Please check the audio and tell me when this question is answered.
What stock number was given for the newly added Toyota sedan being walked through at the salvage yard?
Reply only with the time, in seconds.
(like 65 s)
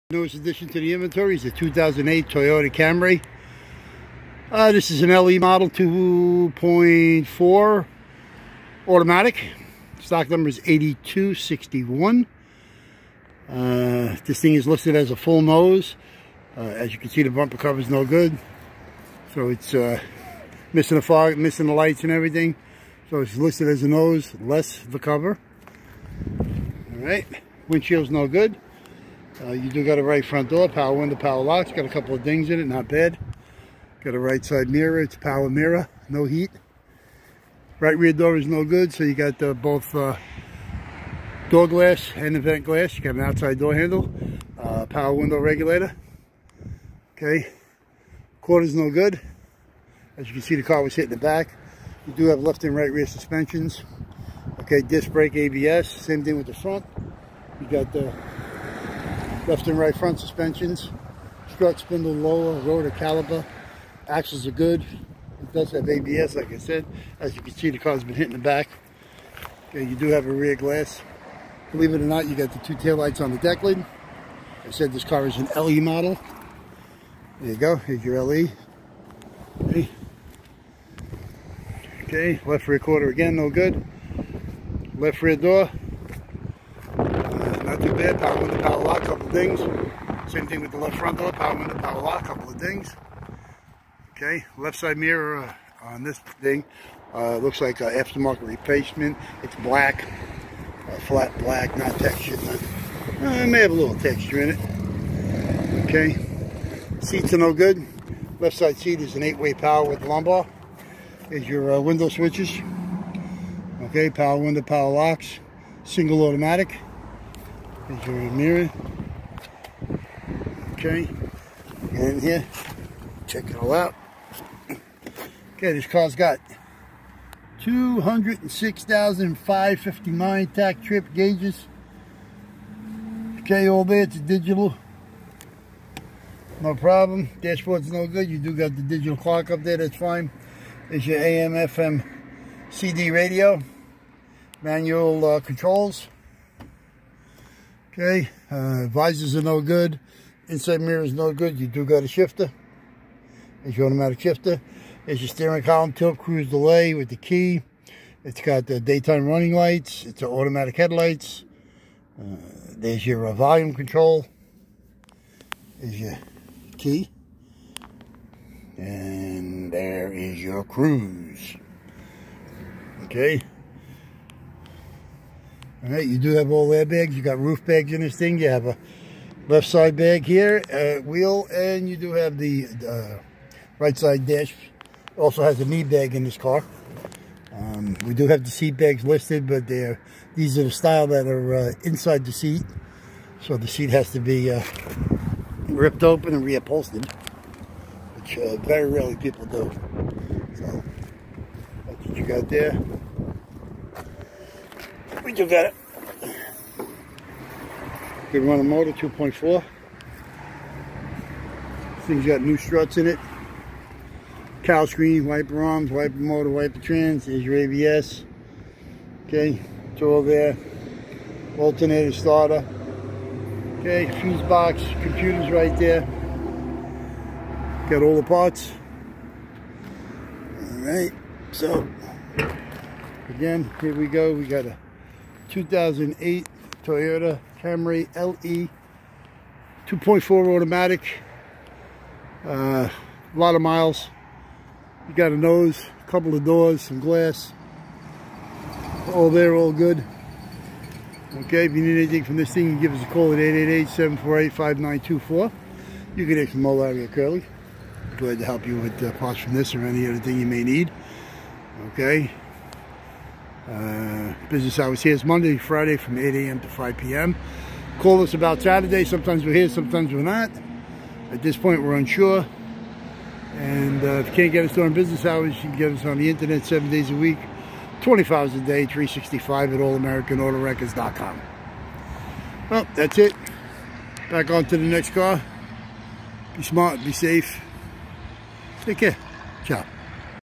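10 s.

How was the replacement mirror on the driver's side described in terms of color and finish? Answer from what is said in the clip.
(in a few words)
flat black.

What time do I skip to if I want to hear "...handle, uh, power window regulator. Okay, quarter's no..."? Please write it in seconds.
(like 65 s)
43 s.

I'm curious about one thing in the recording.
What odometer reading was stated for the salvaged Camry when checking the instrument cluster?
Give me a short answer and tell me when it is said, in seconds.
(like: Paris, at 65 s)
206,559, at 127 s.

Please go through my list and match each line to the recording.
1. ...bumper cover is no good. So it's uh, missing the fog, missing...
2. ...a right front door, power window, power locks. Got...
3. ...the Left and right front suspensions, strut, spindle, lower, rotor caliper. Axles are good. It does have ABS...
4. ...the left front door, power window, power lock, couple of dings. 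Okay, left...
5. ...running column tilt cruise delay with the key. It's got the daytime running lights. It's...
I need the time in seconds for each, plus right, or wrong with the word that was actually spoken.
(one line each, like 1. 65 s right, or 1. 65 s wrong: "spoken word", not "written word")
1. 17 s right
2. 29 s right
3. 57 s right
4. 90 s right
5. 155 s wrong: "steering", not "running".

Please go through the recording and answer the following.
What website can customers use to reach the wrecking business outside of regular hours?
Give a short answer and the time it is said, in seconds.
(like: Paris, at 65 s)
allamericanautowreckers.com, at 279 s.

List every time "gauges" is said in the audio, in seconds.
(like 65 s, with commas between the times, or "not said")
131 s.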